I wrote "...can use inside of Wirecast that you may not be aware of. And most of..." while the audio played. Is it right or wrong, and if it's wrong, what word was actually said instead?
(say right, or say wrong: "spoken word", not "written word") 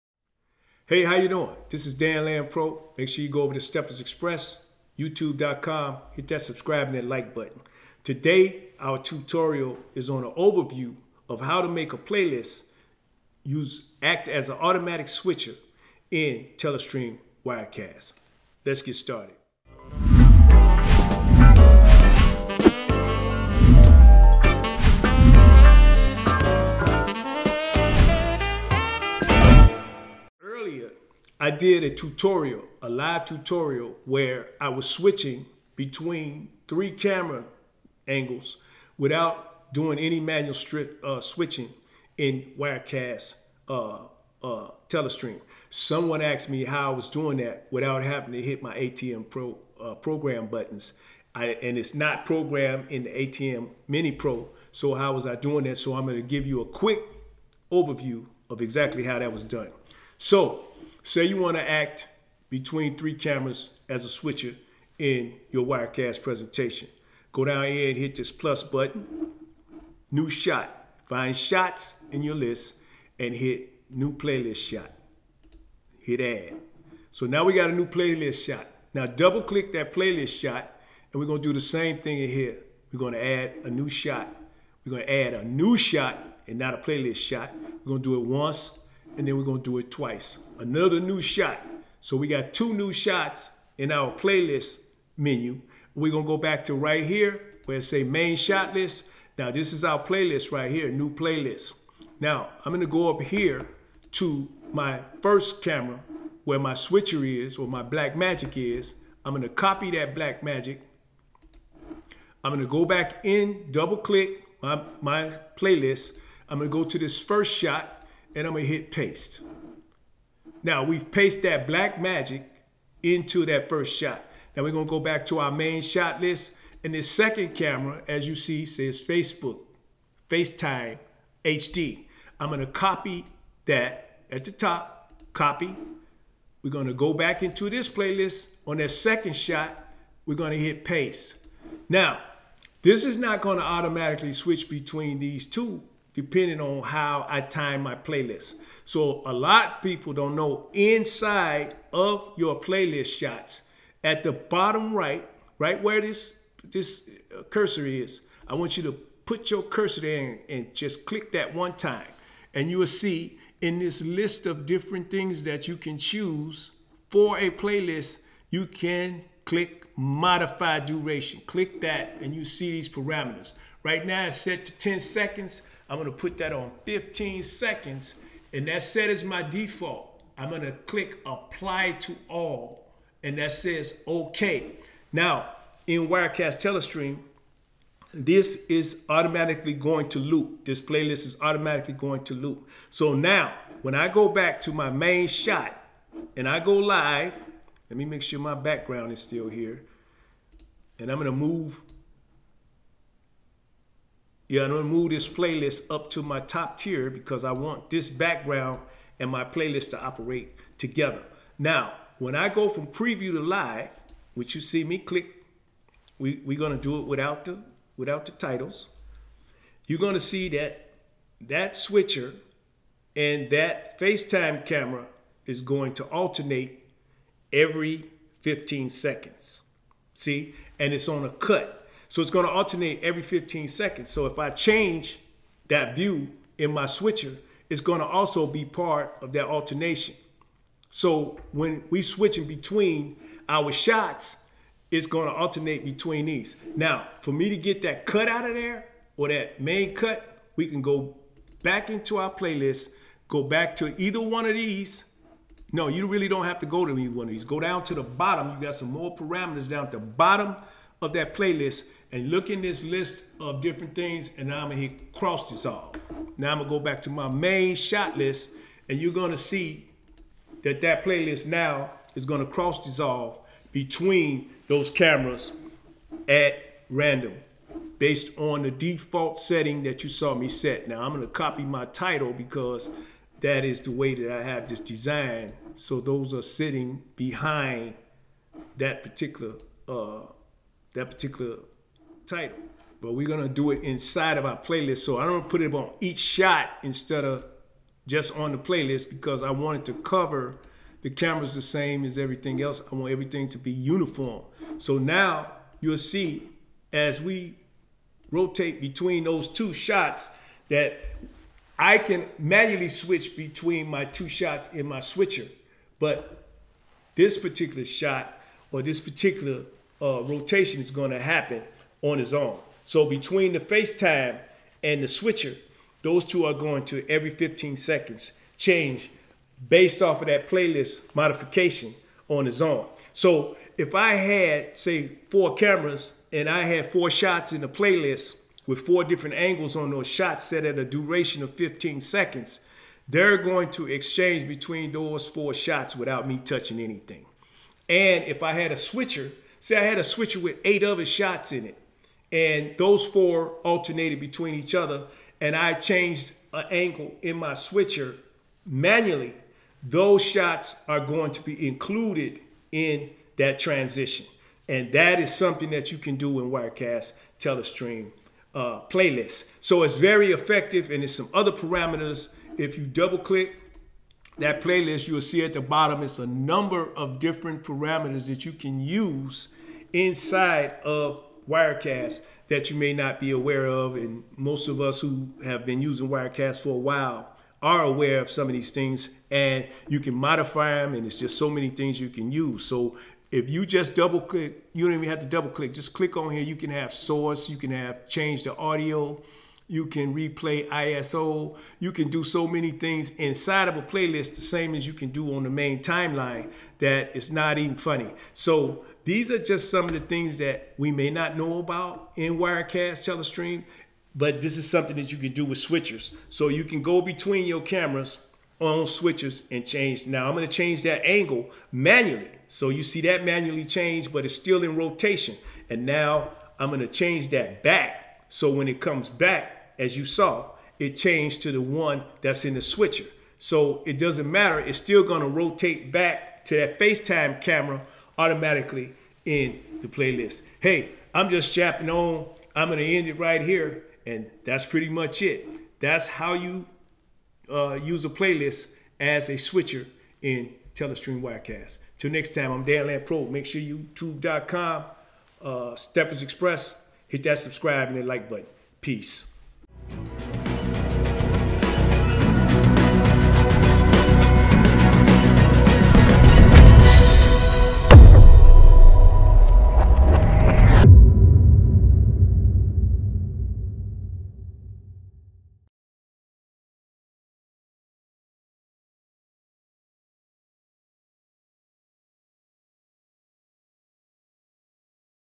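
right.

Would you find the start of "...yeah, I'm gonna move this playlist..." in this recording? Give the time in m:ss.
3:24.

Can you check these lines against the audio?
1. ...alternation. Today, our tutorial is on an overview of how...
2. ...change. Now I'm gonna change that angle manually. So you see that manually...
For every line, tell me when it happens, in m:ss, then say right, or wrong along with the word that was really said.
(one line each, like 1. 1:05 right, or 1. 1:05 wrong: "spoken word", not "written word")
1. 0:07 wrong: "button", not "alternation"
2. 6:59 right.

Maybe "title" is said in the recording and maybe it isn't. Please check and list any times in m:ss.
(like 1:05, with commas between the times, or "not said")
3:38, 4:41, 4:52.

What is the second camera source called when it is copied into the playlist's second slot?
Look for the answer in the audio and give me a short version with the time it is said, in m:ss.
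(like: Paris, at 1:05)
FaceTime HD, at 2:10.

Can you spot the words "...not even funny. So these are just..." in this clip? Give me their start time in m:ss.
6:47.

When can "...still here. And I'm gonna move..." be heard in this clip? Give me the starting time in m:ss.
3:19.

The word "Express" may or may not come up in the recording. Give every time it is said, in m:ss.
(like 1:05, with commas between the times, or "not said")
0:04, 7:36.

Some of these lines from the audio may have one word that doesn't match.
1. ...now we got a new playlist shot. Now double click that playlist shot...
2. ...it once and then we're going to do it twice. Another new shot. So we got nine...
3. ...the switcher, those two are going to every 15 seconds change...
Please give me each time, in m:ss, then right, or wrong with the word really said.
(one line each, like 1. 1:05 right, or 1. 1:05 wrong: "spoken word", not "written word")
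1. 1:17 right
2. 1:28 wrong: "two", not "nine"
3. 5:25 right.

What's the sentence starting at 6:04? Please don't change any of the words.
And that is something that you can do in Wirecast Telestream uh, playlist.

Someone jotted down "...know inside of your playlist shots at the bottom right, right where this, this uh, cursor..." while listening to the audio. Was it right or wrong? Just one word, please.
right.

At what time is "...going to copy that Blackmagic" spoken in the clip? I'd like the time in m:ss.
1:49.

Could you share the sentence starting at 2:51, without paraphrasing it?
Click that and you see these parameters.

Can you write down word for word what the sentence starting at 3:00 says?
I'm gonna click apply to all and that says okay.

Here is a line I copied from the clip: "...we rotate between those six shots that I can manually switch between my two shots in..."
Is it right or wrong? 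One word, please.
wrong.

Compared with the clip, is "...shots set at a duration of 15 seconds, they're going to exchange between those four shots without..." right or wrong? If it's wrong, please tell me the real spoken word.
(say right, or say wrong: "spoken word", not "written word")
right.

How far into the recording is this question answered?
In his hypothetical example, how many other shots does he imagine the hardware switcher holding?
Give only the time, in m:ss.
5:50.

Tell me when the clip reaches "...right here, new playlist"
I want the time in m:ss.
1:40.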